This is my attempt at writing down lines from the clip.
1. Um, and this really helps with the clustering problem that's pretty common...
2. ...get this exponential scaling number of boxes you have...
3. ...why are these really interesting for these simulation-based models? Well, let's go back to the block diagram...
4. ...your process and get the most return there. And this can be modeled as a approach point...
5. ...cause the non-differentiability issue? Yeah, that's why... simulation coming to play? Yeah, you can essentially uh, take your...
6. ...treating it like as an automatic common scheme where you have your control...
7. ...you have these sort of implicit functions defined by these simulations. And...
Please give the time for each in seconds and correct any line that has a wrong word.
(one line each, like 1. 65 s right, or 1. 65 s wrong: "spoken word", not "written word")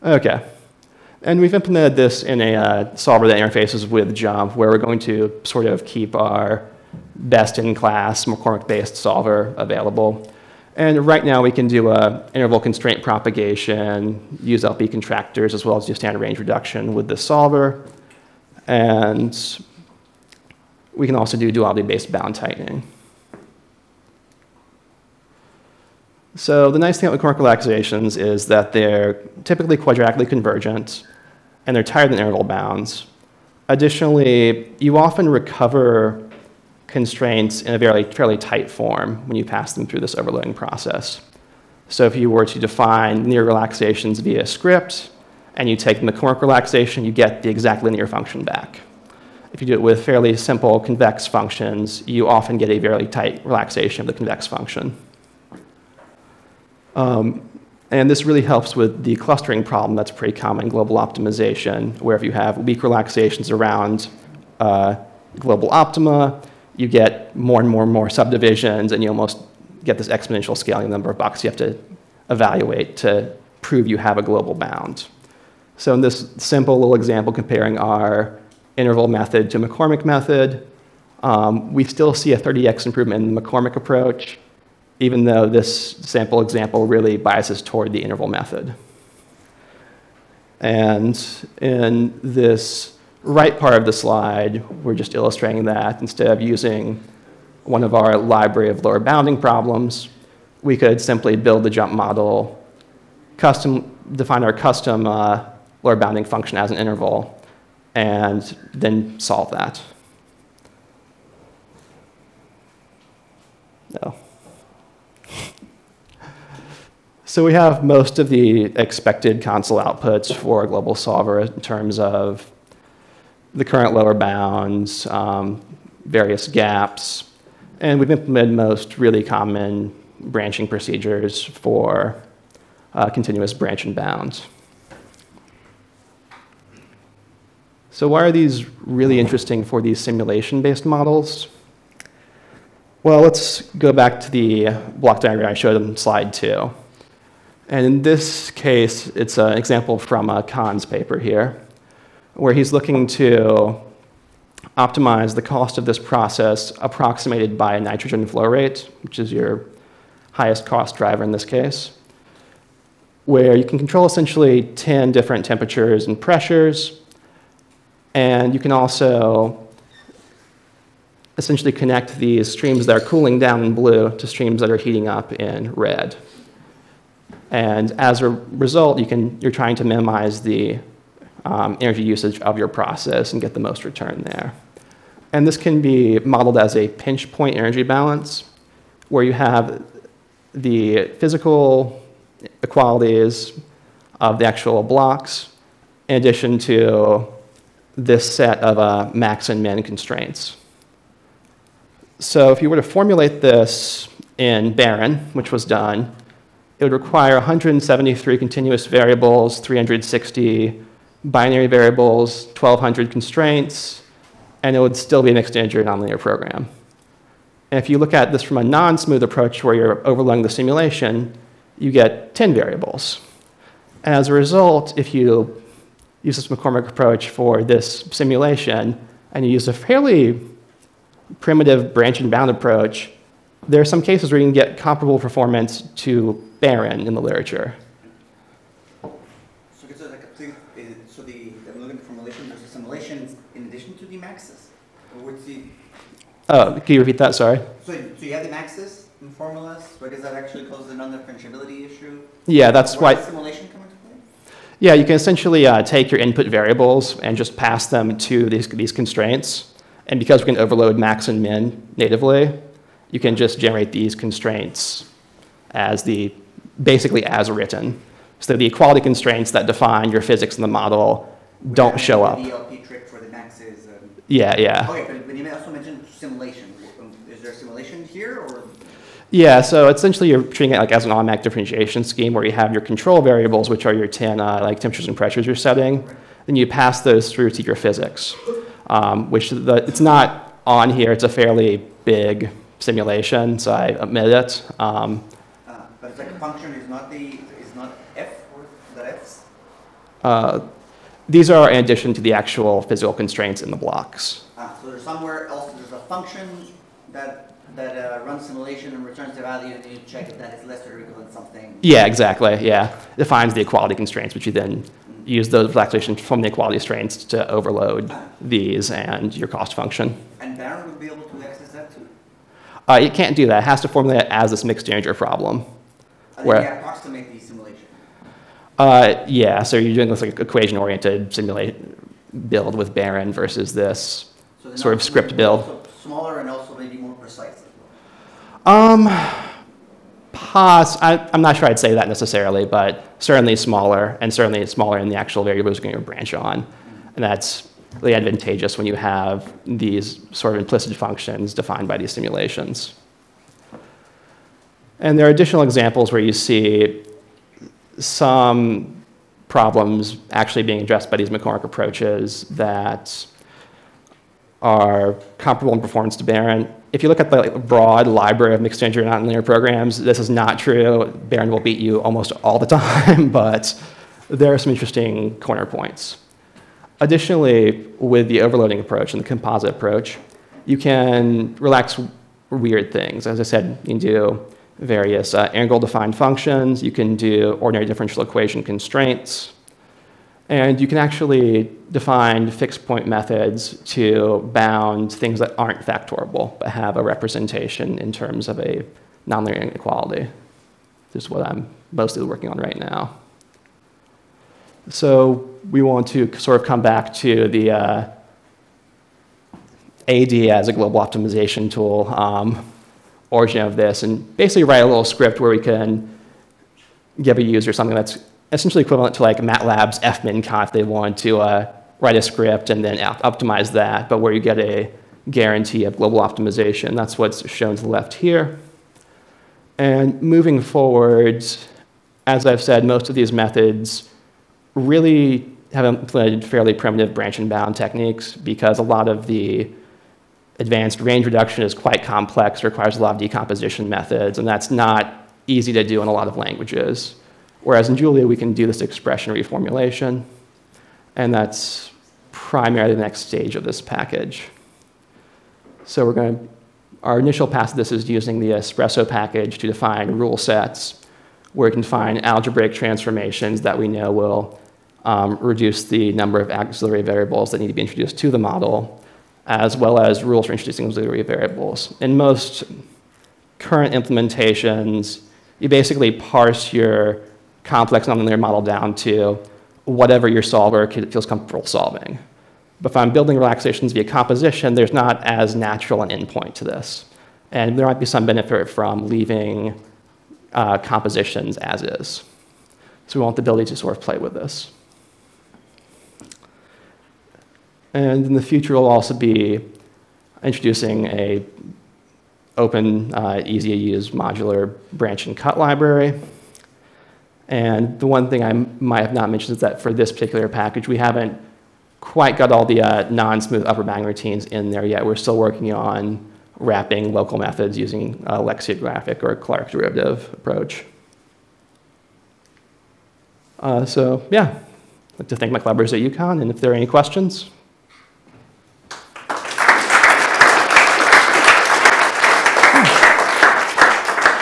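1. 56 s right
2. 69 s right
3. 138 s right
4. 182 s wrong: "pinch", not "approach"
5. 250 s right
6. 280 s wrong: "differentiation", not "common"
7. 348 s right.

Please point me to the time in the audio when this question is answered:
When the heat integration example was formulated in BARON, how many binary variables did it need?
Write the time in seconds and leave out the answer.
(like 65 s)
209 s.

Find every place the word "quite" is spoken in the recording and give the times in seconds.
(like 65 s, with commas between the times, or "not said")
441 s, 511 s.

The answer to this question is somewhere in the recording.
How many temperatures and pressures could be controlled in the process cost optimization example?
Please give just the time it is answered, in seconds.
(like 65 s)
164 s.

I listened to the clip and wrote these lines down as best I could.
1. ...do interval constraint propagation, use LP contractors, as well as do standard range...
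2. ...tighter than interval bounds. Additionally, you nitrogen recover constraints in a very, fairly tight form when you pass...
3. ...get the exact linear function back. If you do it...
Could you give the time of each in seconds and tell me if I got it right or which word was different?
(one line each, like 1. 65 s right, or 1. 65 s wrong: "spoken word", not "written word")
1. 11 s right
2. 31 s wrong: "often", not "nitrogen"
3. 47 s right.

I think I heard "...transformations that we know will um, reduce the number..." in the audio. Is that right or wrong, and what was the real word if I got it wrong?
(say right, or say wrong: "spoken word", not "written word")
right.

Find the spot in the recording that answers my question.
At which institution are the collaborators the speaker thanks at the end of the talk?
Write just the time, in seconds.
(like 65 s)
525 s.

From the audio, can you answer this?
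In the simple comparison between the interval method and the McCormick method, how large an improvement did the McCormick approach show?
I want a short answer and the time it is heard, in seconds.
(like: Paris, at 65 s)
30x, at 82 s.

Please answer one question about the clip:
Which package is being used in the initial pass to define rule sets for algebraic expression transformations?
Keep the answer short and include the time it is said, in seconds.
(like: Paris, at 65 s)
espresso, at 458 s.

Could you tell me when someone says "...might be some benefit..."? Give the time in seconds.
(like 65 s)
487 s.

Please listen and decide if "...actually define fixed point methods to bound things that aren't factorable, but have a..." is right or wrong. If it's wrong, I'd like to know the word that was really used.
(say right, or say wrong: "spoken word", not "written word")
right.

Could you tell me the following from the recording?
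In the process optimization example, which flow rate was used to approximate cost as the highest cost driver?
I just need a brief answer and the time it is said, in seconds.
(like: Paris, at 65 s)
nitrogen flow rate, at 157 s.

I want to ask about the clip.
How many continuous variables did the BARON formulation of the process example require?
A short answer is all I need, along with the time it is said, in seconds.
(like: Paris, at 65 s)
173, at 207 s.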